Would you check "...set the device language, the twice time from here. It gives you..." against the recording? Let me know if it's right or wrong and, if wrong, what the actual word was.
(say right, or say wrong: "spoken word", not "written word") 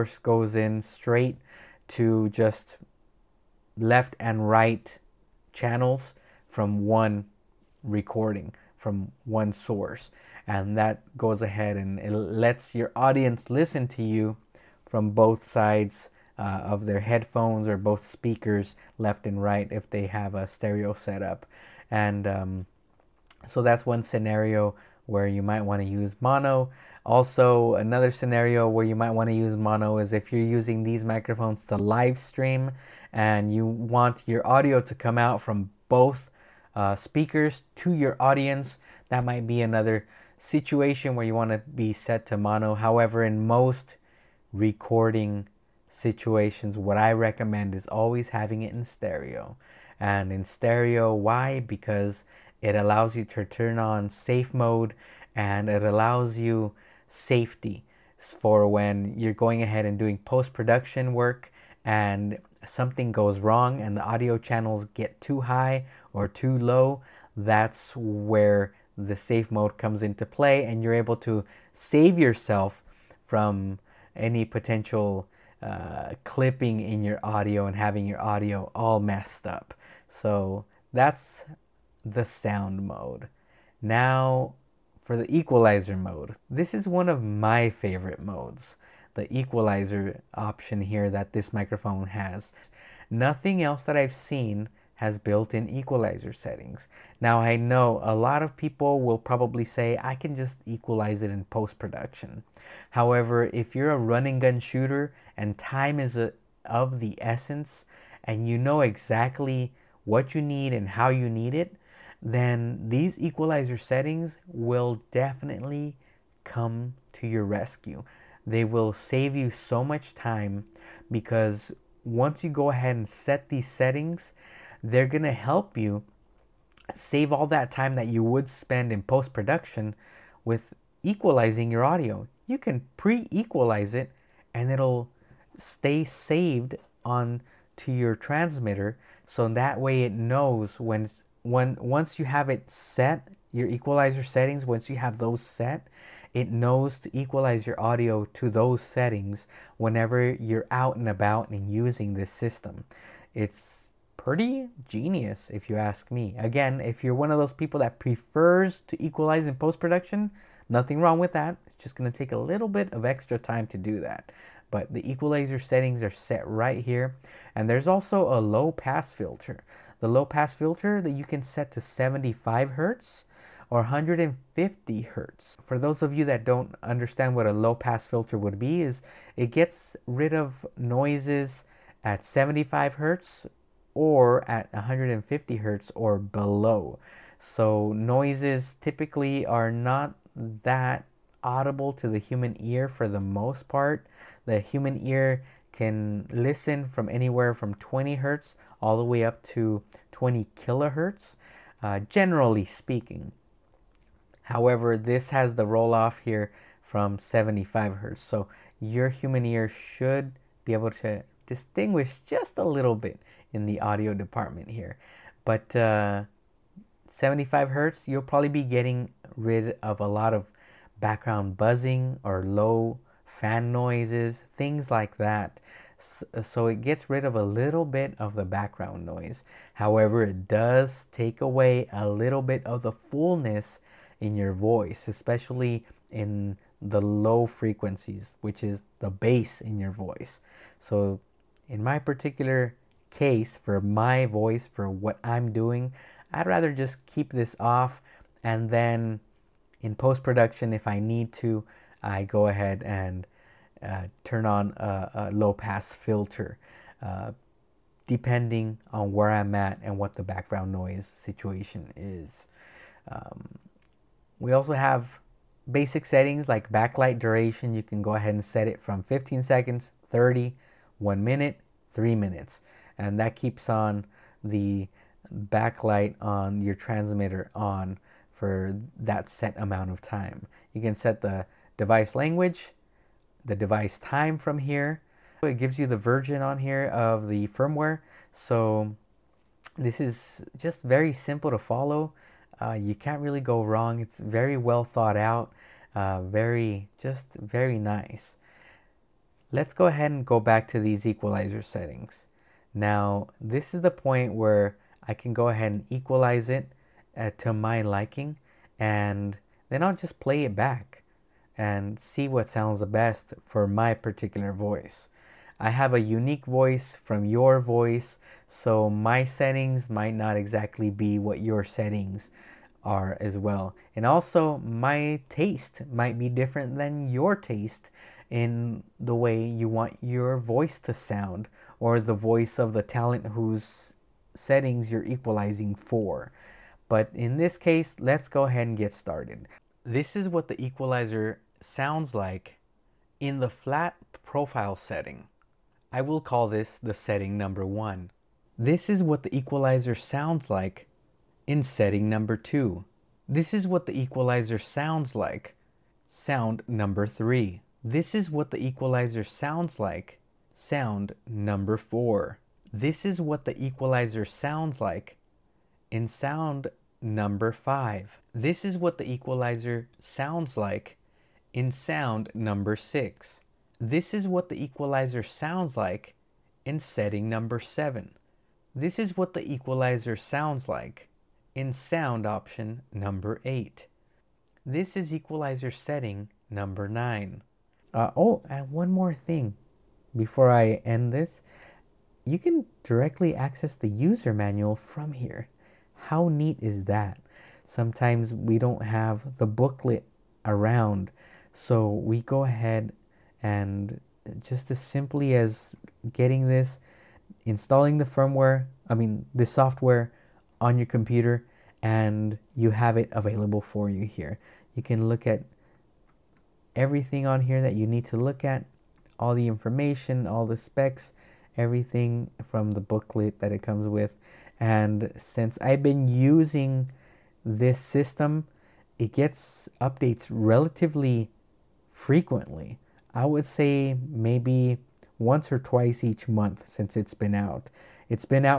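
wrong: "device", not "twice".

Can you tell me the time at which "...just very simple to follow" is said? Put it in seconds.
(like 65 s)
290 s.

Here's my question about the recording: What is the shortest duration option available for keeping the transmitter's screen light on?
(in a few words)
15 seconds.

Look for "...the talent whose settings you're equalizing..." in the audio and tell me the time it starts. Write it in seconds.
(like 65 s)
332 s.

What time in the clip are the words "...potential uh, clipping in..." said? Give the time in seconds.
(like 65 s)
74 s.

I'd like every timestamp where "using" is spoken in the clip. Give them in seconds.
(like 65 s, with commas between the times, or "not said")
30 s, 151 s, 426 s.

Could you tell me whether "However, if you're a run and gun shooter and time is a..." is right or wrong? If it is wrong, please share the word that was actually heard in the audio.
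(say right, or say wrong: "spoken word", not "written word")
right.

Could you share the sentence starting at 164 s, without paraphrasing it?
But the equalizer settings are set right here.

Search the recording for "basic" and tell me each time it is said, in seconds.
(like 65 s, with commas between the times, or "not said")
265 s.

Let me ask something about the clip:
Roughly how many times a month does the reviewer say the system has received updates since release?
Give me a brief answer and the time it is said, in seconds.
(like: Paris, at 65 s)
Once or twice, at 435 s.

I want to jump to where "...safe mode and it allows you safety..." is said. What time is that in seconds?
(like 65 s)
54 s.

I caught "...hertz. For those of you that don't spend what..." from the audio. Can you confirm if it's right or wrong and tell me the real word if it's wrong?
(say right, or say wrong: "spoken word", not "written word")
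wrong: "understand", not "spend".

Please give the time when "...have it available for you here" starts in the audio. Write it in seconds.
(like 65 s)
412 s.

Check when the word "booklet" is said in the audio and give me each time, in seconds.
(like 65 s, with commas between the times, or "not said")
399 s, 422 s.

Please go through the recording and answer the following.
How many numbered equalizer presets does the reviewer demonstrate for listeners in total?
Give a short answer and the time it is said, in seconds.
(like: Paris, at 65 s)
9, at 386 s.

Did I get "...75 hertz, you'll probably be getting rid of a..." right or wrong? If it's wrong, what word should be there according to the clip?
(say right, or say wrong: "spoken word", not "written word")
right.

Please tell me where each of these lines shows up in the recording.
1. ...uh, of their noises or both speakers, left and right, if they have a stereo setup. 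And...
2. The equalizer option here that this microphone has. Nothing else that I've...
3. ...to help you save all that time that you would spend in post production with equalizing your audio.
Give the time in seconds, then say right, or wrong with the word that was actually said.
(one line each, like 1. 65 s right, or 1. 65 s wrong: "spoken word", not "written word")
1. 16 s wrong: "headphones", not "noises"
2. 89 s right
3. 125 s right.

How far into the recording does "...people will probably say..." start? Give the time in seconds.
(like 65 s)
98 s.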